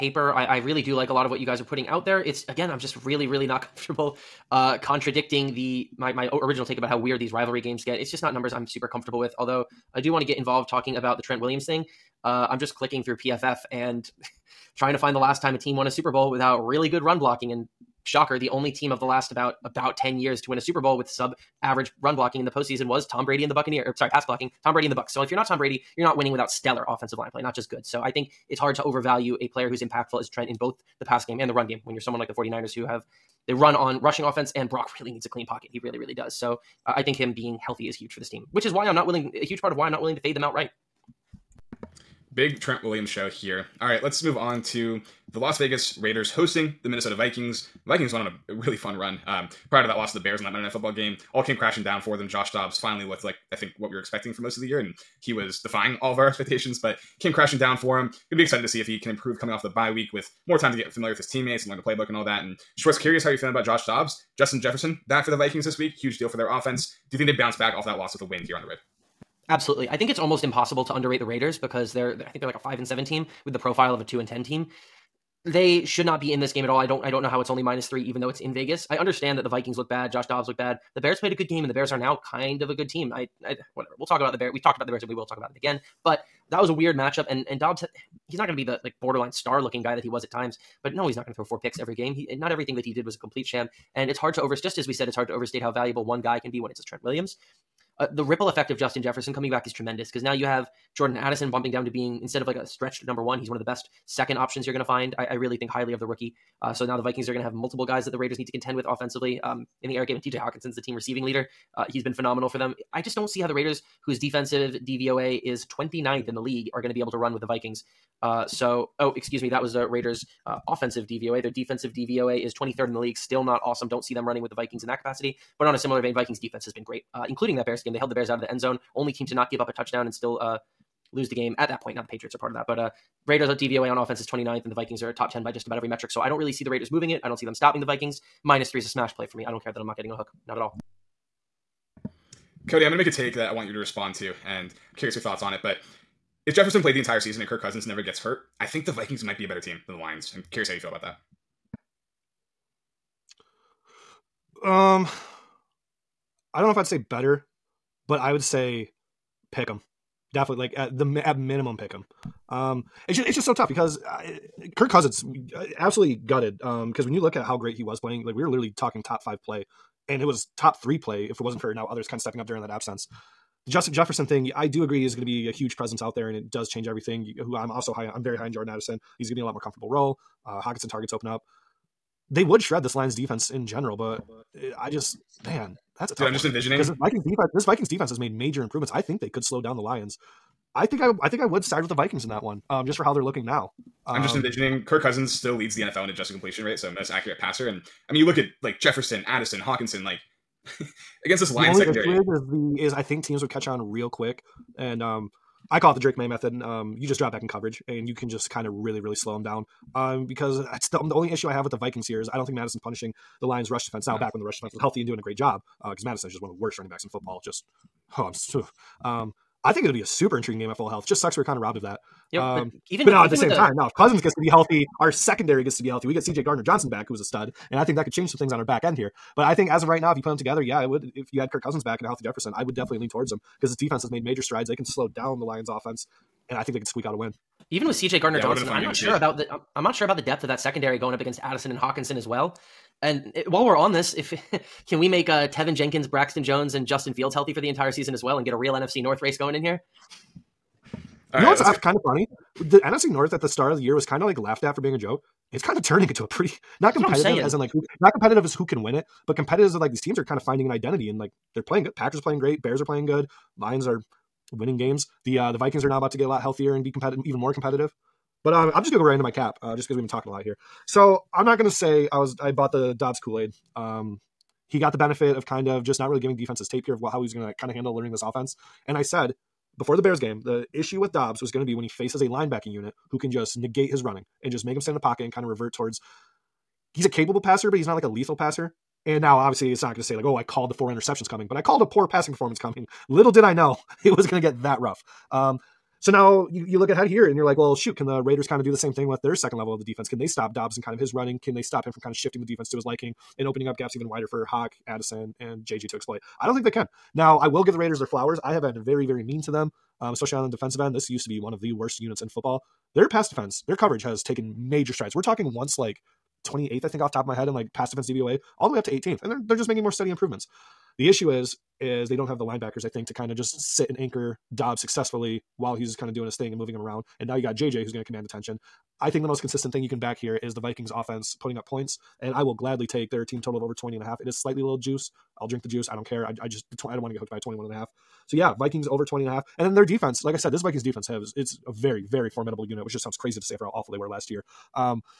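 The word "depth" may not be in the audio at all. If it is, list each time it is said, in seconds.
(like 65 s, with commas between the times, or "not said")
240 s.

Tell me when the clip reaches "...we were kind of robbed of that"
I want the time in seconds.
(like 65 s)
221 s.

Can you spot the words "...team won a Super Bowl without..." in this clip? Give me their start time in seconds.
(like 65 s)
15 s.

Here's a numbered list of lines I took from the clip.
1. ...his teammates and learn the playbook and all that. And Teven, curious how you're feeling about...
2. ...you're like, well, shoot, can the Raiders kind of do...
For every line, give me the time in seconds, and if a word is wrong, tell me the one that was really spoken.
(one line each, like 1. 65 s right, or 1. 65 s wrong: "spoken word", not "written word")
1. 61 s wrong: "Schwartz", not "Teven"
2. 297 s right.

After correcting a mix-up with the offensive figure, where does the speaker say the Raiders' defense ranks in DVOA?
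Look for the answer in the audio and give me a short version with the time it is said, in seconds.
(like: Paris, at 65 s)
23rd, at 122 s.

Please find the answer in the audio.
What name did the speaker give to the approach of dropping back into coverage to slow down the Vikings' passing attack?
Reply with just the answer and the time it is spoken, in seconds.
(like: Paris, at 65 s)
Drake Maye method, at 205 s.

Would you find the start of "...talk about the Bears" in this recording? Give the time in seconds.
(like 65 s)
84 s.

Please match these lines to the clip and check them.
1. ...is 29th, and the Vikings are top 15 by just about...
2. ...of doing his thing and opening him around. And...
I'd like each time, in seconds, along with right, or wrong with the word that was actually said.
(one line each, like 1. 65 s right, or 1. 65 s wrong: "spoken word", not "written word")
1. 134 s wrong: "10", not "15"
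2. 326 s wrong: "moving", not "opening".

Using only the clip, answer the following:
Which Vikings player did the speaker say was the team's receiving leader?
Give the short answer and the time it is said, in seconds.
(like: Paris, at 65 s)
TJ Hockenson, at 110 s.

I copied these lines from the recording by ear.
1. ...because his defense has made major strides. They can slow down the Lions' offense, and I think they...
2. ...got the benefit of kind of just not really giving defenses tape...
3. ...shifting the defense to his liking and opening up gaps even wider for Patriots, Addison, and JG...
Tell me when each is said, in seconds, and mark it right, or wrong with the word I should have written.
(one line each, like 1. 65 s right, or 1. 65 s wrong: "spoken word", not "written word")
1. 233 s right
2. 274 s right
3. 302 s wrong: "Hawk", not "Patriots".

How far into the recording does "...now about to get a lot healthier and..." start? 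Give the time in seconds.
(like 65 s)
265 s.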